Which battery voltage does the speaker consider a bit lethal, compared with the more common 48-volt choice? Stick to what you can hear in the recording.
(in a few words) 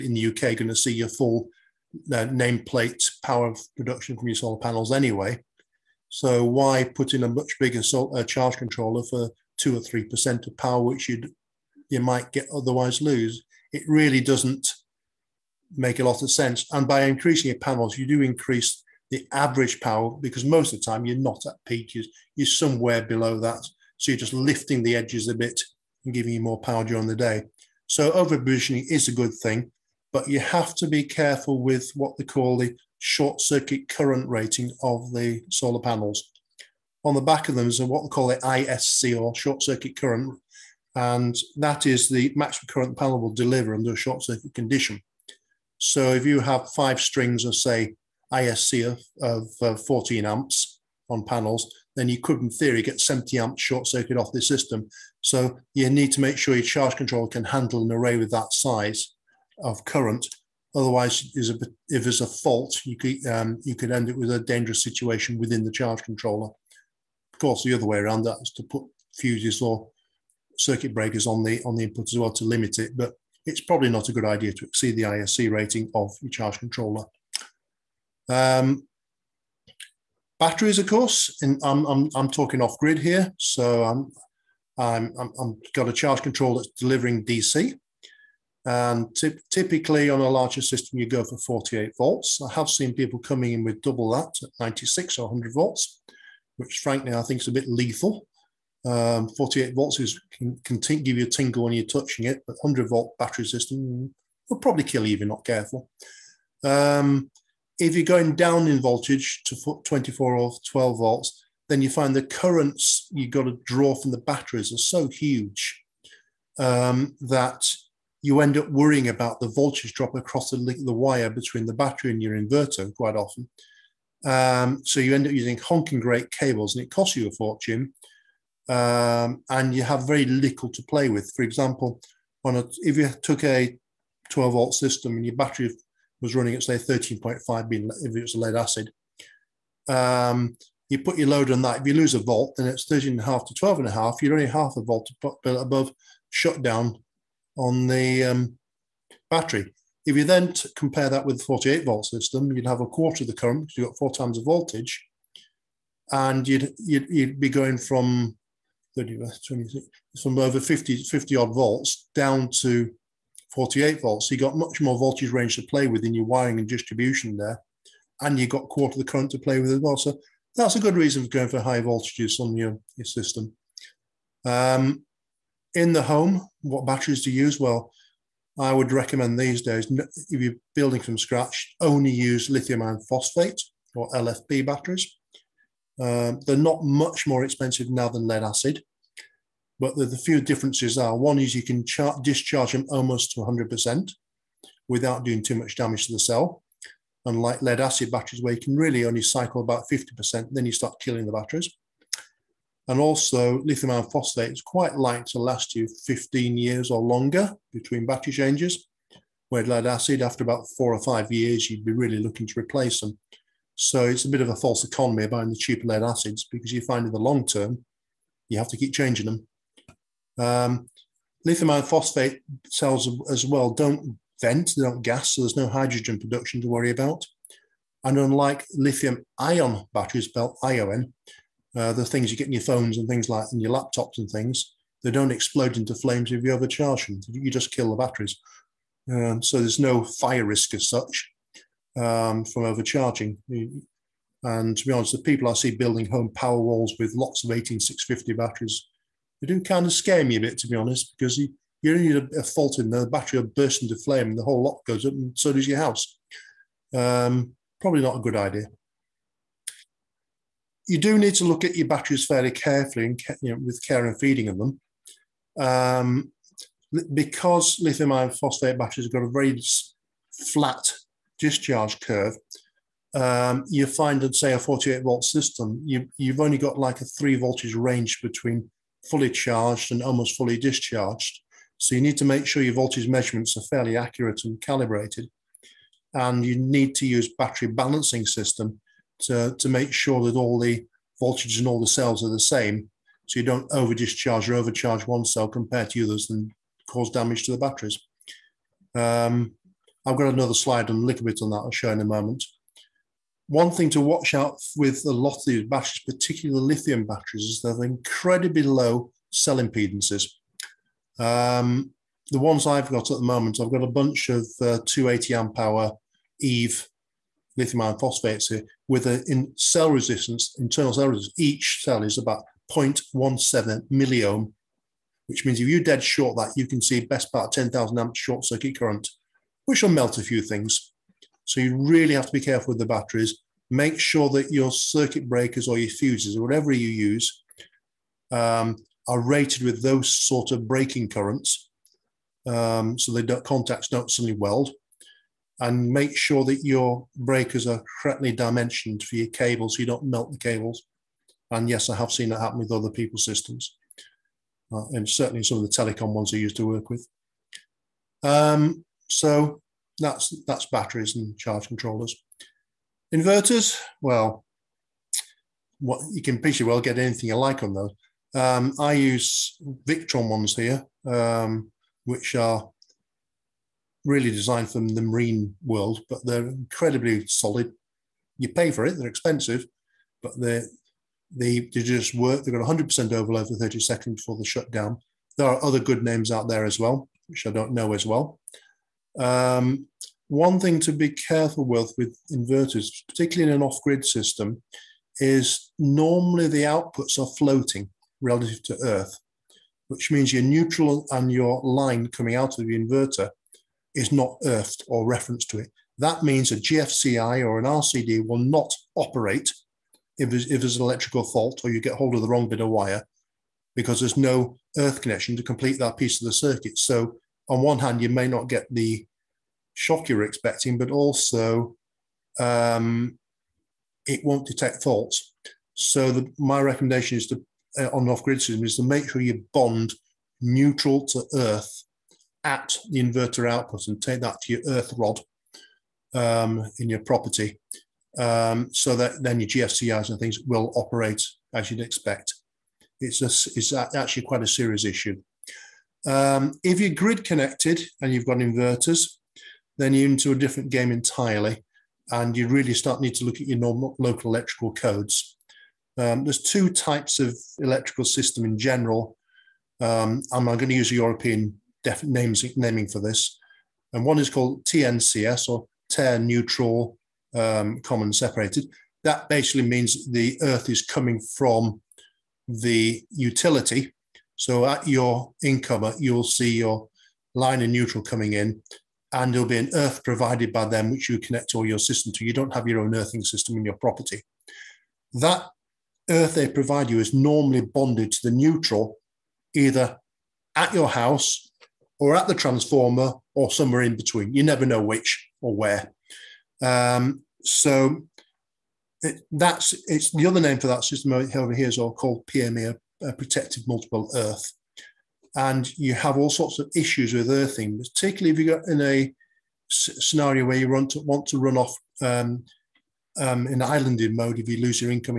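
100 volts.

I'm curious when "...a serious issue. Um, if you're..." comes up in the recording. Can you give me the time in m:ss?
7:24.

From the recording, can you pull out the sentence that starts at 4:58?
Um, I've got another slide and a little bit on that I'll show in a moment.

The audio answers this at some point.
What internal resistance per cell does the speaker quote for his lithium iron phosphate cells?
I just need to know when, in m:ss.
5:22.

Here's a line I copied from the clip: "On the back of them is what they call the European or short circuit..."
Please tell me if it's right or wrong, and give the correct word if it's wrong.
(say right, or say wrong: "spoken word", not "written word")
wrong: "ISC", not "European".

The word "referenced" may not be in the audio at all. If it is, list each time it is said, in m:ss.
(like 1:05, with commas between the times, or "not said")
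6:45.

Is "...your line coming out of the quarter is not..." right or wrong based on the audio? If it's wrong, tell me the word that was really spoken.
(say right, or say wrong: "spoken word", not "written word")
wrong: "inverter", not "quarter".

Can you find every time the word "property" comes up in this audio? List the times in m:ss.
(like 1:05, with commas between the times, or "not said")
7:17, 8:03.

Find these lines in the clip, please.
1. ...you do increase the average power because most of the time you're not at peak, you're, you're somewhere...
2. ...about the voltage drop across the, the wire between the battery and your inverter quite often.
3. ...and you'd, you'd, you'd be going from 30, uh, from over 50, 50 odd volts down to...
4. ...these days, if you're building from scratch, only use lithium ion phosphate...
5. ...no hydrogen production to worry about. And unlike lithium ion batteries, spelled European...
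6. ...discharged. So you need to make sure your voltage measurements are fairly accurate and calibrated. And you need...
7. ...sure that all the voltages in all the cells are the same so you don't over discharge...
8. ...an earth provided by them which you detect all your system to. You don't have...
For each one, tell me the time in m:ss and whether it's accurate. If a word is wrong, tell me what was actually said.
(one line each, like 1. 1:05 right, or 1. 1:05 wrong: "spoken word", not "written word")
1. 0:17 right
2. 1:59 right
3. 2:36 right
4. 2:59 right
5. 3:45 wrong: "ION", not "European"
6. 4:40 right
7. 4:49 right
8. 7:59 wrong: "connect", not "detect".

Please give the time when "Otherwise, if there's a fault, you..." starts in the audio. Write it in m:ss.
1:00.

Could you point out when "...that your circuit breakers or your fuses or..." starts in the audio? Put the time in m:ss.
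5:34.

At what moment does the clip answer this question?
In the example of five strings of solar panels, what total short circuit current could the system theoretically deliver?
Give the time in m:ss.
0:53.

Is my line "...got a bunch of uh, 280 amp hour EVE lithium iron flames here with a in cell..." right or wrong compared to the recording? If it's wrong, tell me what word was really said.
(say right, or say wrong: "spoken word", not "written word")
wrong: "phosphates", not "flames".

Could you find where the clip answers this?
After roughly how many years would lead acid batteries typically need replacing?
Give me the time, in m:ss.
3:30.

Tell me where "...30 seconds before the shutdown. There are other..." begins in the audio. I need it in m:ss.
6:23.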